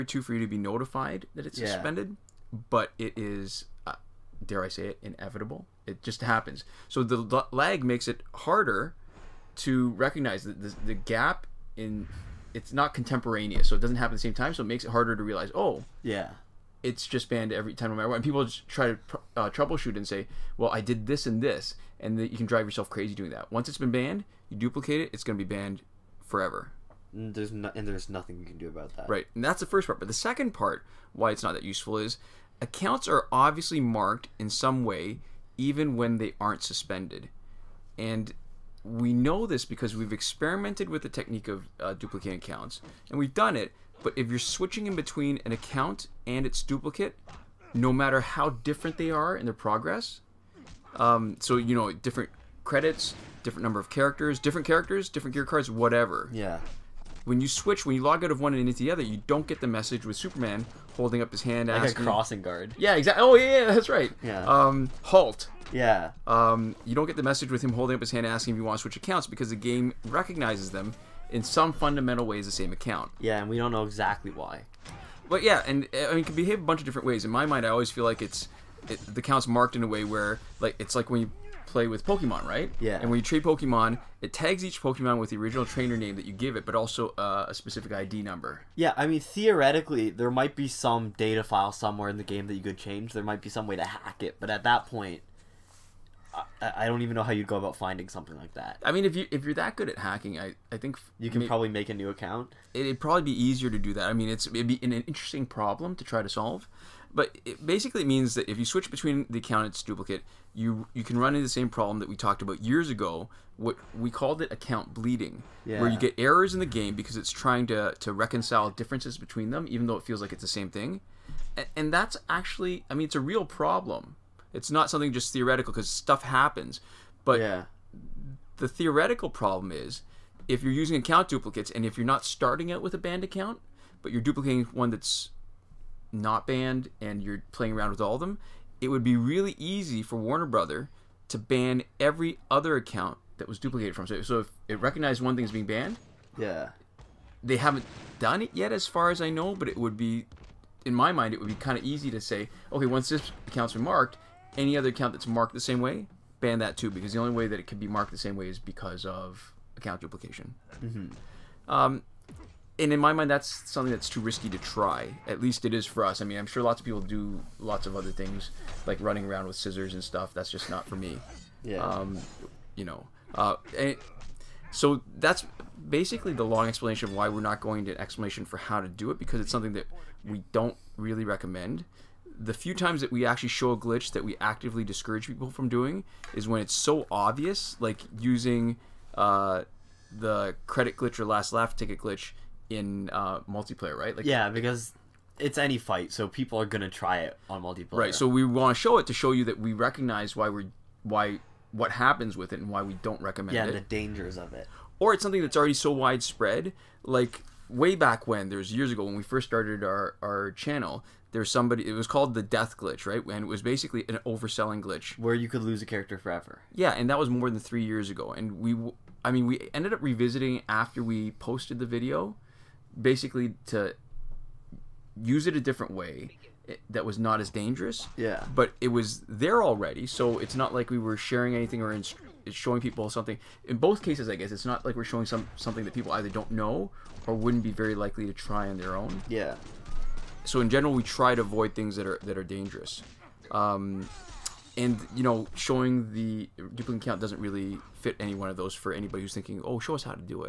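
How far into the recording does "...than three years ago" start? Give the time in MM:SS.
03:37.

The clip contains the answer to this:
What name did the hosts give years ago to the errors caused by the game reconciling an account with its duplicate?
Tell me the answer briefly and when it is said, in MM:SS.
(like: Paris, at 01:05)
account bleeding, at 01:54.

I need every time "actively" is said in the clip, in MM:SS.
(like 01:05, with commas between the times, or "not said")
03:04.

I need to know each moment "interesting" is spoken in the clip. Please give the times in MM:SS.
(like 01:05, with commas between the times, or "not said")
01:44.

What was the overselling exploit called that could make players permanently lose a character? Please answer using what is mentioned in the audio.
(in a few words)
the death glitch.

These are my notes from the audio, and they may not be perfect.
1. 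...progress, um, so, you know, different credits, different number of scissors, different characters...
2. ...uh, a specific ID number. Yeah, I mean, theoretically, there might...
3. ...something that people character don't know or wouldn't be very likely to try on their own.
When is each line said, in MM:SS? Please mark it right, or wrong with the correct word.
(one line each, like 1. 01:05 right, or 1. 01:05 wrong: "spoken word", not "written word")
1. 00:49 wrong: "characters", not "scissors"
2. 01:27 right
3. 03:55 wrong: "either", not "character".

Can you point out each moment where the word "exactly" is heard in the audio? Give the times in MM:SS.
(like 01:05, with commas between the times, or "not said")
01:02, 01:13.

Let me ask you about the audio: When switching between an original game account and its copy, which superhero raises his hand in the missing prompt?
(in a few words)
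Superman.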